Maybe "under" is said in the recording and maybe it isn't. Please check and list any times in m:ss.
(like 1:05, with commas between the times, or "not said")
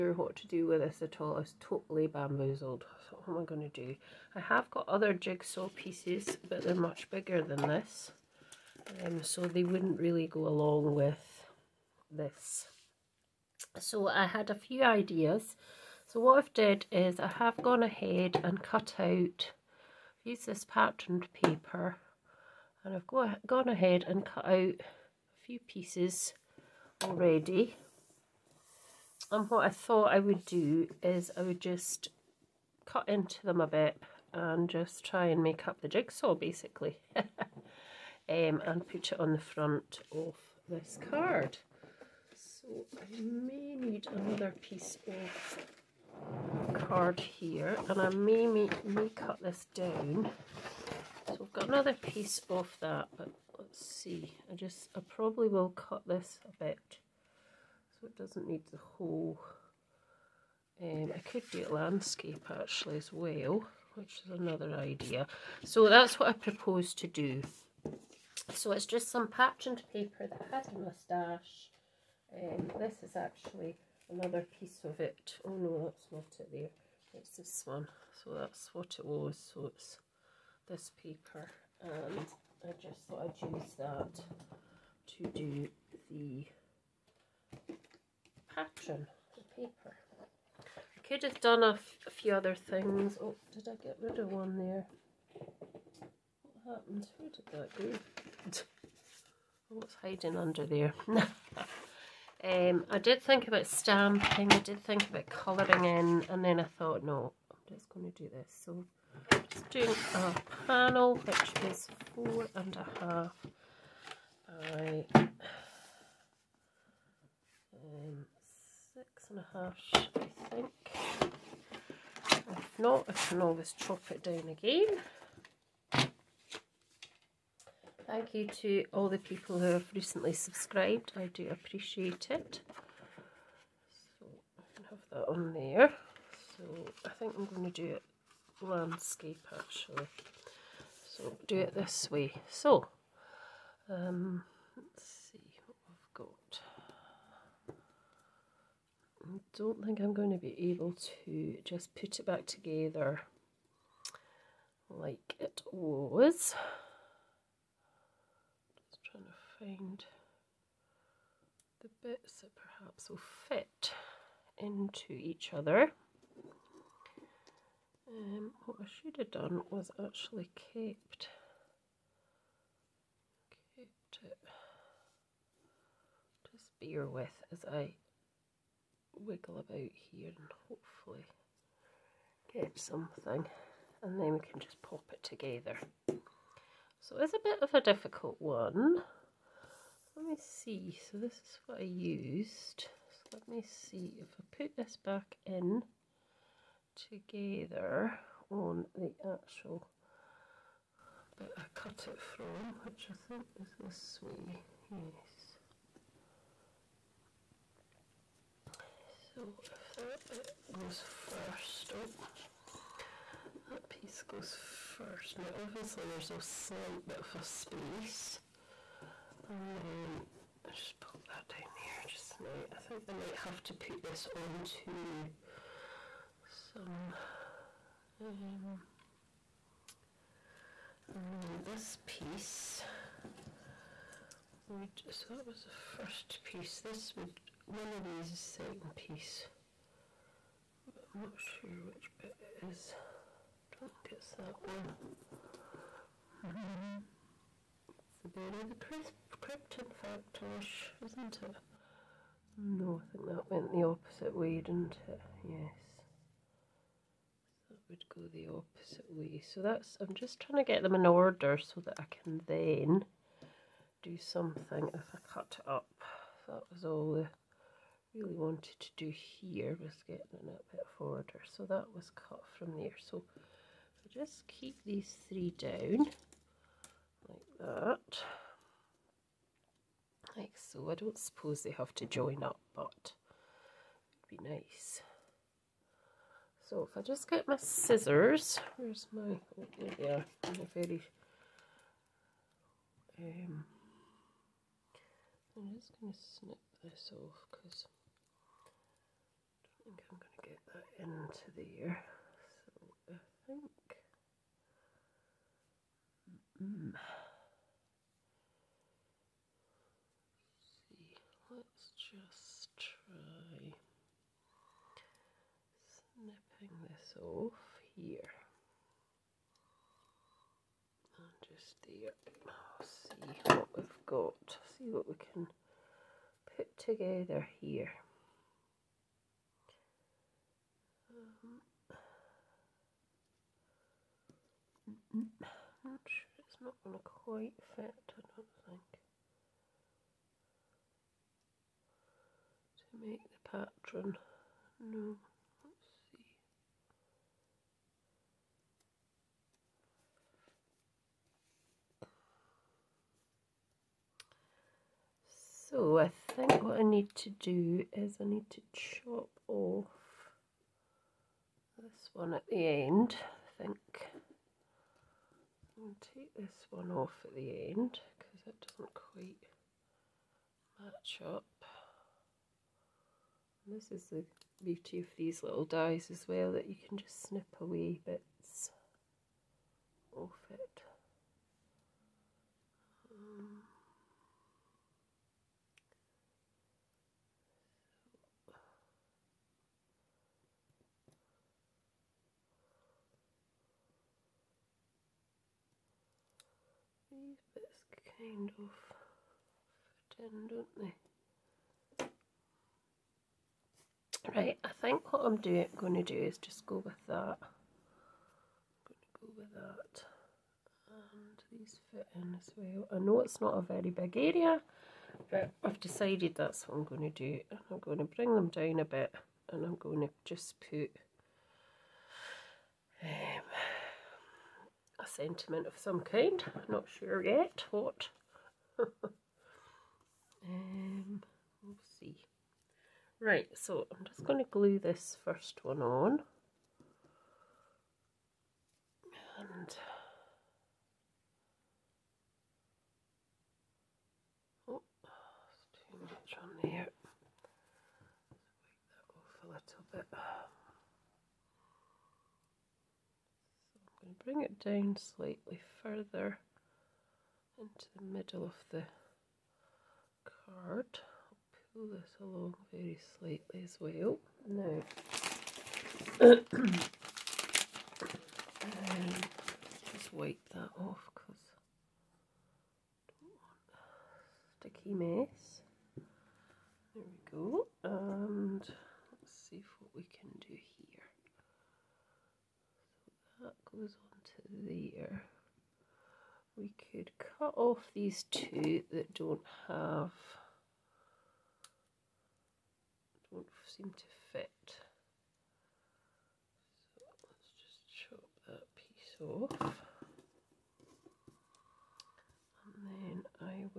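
1:40.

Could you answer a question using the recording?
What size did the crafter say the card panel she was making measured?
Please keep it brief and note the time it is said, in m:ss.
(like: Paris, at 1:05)
4 and a half, at 1:52.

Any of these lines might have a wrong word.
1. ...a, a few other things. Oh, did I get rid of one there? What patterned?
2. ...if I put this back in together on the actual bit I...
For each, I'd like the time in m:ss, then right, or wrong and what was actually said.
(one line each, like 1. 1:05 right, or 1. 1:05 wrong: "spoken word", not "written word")
1. 1:31 wrong: "happened", not "patterned"
2. 3:14 right.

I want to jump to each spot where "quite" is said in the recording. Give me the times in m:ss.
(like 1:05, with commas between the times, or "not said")
5:37, 6:08.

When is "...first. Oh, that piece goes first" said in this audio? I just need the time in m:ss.
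3:31.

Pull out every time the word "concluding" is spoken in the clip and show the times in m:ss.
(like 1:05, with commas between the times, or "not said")
not said.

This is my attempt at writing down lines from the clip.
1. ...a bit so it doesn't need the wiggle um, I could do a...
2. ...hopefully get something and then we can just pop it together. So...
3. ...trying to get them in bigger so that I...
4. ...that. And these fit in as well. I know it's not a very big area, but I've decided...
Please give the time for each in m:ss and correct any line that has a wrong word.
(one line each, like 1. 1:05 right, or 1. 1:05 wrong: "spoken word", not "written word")
1. 0:56 wrong: "whole", not "wiggle"
2. 3:00 right
3. 4:20 wrong: "order", not "bigger"
4. 6:49 right.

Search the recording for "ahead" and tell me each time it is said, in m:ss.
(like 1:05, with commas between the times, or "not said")
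0:17, 0:23.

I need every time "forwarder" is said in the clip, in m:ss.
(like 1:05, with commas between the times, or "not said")
4:30.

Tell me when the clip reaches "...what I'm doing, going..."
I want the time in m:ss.
6:45.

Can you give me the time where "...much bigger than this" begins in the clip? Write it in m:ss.
0:06.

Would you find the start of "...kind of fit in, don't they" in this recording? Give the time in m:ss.
6:38.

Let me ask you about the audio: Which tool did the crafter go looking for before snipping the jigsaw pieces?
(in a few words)
scissors.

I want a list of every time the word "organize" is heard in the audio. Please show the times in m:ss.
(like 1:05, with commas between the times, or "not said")
not said.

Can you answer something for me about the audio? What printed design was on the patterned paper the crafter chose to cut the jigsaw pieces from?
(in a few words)
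moustache.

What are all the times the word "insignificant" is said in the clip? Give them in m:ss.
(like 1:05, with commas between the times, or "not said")
not said.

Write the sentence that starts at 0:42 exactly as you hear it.
So I may need another piece of card here and I may, may, may cut this down.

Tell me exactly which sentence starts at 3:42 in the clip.
I think I might have to put this onto some.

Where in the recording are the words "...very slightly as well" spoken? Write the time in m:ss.
7:42.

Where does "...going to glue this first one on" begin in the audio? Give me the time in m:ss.
7:14.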